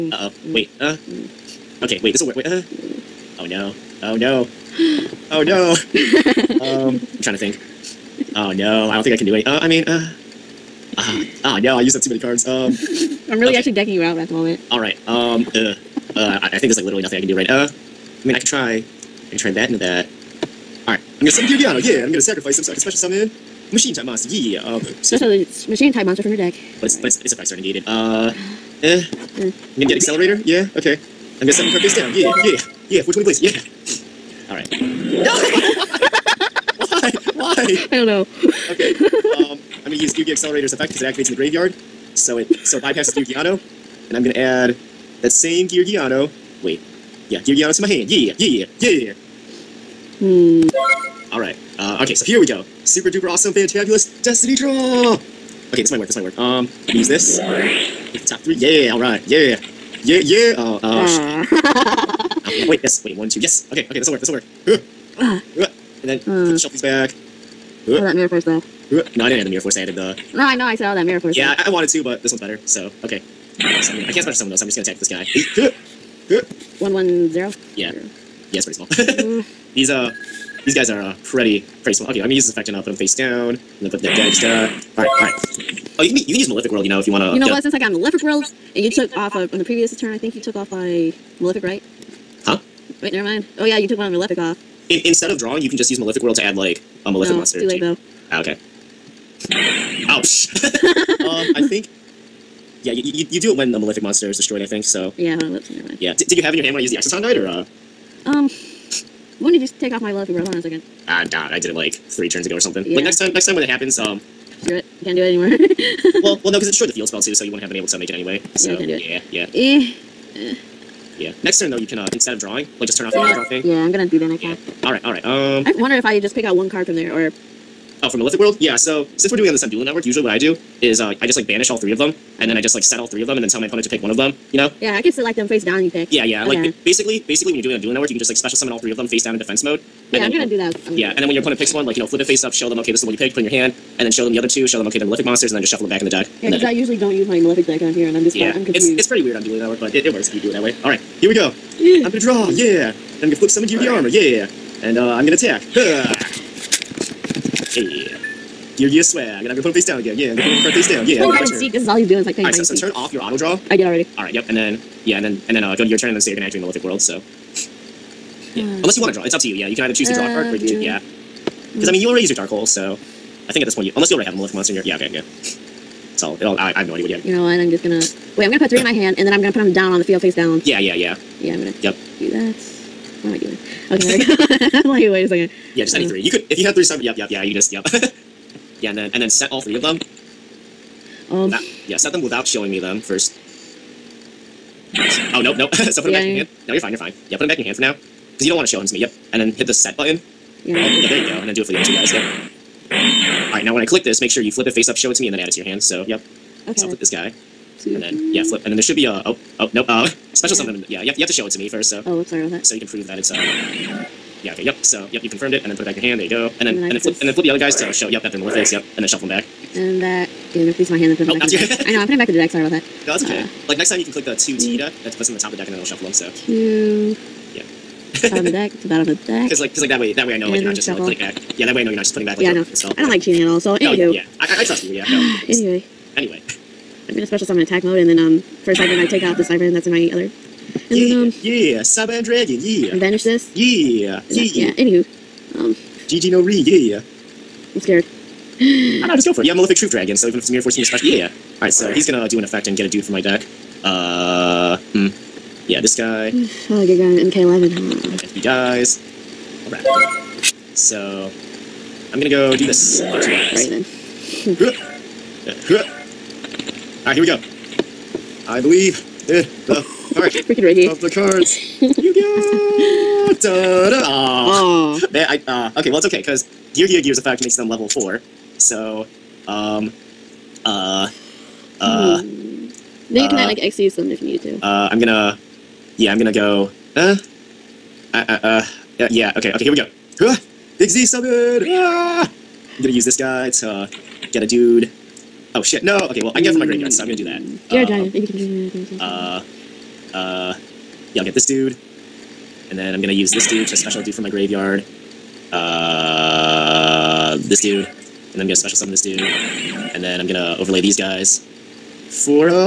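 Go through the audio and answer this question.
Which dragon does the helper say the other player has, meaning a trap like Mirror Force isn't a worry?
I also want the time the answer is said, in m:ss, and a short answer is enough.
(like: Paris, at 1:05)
Malefic Truth Dragon, at 4:09.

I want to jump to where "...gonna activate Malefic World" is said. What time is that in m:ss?
2:46.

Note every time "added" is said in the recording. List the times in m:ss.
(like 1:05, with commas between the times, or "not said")
1:09.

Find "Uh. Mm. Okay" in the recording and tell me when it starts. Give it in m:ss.
0:00.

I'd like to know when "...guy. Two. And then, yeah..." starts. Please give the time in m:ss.
3:27.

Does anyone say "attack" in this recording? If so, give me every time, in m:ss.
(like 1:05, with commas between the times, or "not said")
1:14, 2:35, 3:57.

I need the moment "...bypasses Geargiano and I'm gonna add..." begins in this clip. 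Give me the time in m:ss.
0:42.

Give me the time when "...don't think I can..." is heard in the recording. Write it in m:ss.
0:08.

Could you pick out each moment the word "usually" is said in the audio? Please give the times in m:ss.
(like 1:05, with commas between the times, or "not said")
2:10, 2:26.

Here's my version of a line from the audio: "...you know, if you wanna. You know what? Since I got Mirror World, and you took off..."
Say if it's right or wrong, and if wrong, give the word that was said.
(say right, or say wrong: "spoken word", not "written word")
wrong: "Malefic", not "Mirror".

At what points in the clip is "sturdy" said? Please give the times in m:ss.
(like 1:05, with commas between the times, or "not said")
not said.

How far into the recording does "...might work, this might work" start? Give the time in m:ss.
0:55.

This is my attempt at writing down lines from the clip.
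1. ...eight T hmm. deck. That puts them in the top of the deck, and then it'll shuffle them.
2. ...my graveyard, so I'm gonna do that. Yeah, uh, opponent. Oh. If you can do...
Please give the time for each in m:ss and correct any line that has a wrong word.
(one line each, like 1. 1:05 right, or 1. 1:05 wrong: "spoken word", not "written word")
1. 3:44 wrong: "two", not "eight"
2. 4:56 wrong: "giant", not "opponent".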